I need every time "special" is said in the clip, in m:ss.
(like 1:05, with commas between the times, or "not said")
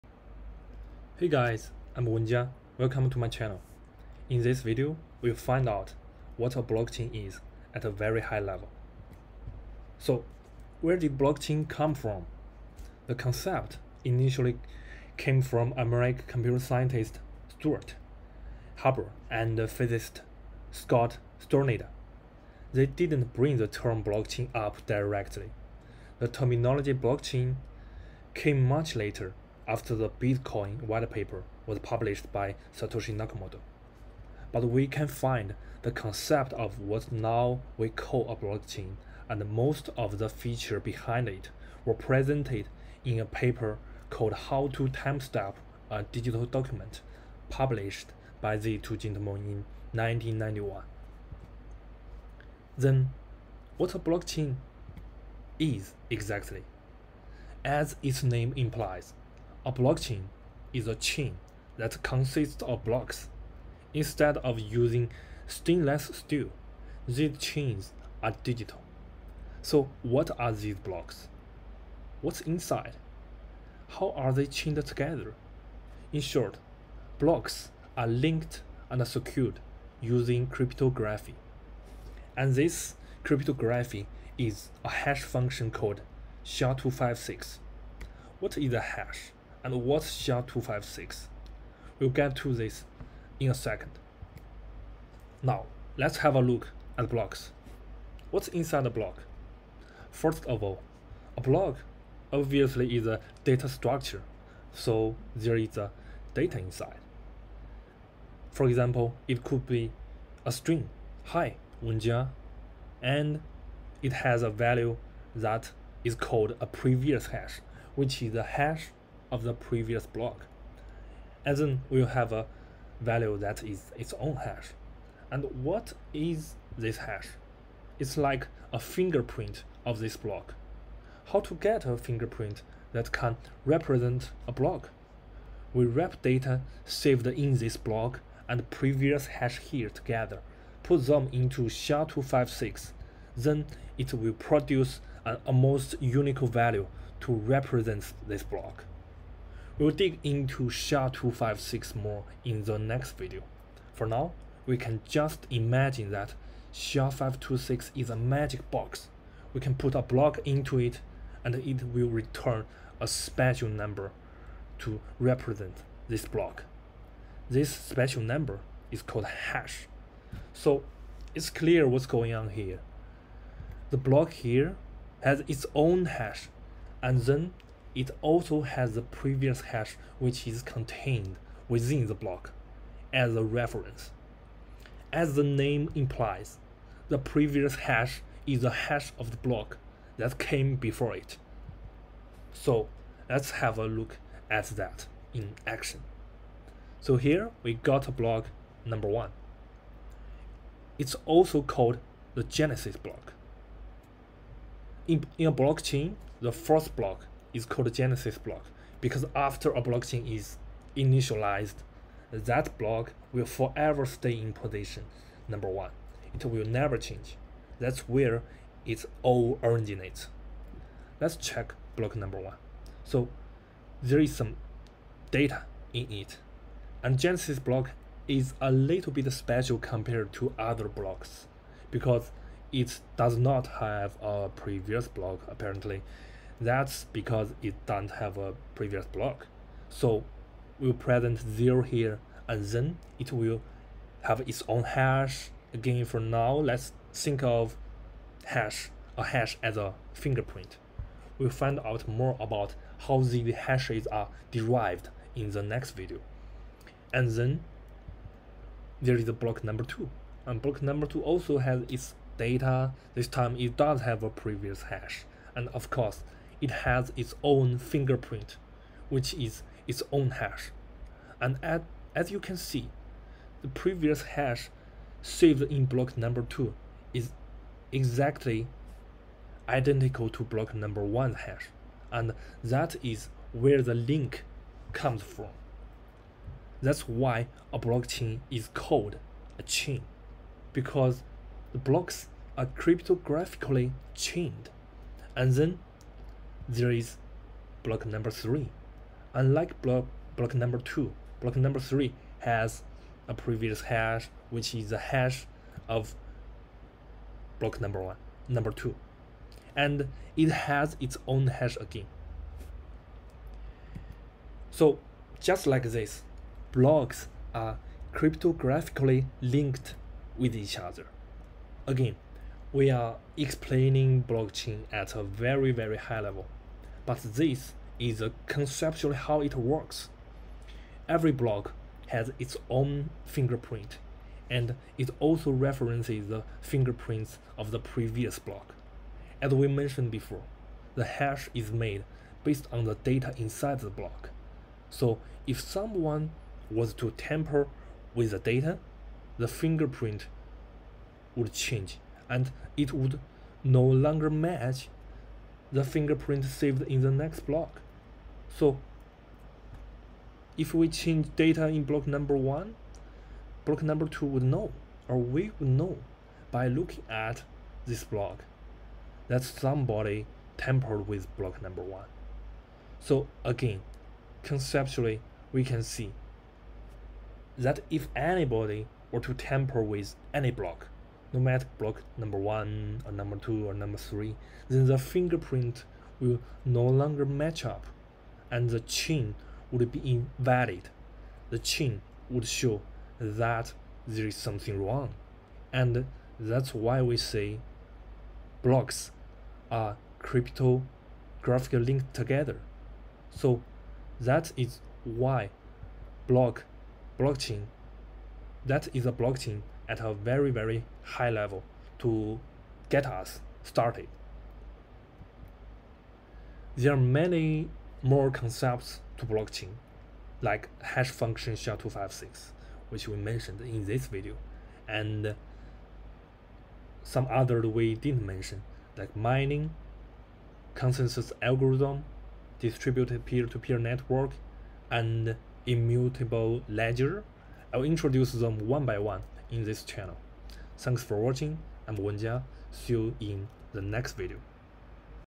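2:43, 2:47, 3:49.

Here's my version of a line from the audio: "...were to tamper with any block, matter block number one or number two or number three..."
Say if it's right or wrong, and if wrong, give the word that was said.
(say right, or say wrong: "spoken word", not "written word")
right.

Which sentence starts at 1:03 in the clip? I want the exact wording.
Instead of using stainless steel, these chains are digital.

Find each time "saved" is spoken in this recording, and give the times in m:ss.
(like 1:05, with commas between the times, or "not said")
2:16, 4:35, 5:56.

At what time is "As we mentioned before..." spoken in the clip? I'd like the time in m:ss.
5:39.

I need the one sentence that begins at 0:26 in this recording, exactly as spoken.
The terminology blockchain came much later after the Bitcoin white paper was published by Satoshi Nakamoto.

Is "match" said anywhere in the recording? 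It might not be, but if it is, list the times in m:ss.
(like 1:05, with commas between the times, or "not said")
5:54, 6:27.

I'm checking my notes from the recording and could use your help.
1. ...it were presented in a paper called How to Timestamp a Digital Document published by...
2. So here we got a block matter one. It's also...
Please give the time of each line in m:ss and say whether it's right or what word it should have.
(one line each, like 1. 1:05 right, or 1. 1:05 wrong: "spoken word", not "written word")
1. 0:41 right
2. 3:17 wrong: "number", not "matter".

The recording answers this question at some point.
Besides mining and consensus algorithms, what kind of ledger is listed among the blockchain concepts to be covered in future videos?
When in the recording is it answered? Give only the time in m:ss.
7:15.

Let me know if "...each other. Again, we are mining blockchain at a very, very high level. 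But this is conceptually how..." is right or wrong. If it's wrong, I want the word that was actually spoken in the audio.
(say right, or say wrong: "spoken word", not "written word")
wrong: "explaining", not "mining".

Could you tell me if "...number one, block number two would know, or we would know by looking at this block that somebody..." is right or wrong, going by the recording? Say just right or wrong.
right.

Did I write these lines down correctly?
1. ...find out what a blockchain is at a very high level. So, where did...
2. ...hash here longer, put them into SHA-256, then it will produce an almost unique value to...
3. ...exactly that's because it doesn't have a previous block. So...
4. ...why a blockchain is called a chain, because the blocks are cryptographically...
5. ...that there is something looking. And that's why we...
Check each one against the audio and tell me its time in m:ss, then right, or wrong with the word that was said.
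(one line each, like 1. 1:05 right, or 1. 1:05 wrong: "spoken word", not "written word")
1. 0:05 right
2. 2:19 wrong: "together", not "longer"
3. 3:55 wrong: "apparently", not "exactly"
4. 4:47 right
5. 6:33 wrong: "wrong", not "looking".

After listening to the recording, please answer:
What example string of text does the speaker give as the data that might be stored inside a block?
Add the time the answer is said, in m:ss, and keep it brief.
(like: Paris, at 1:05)
hi, Wenjia, at 1:51.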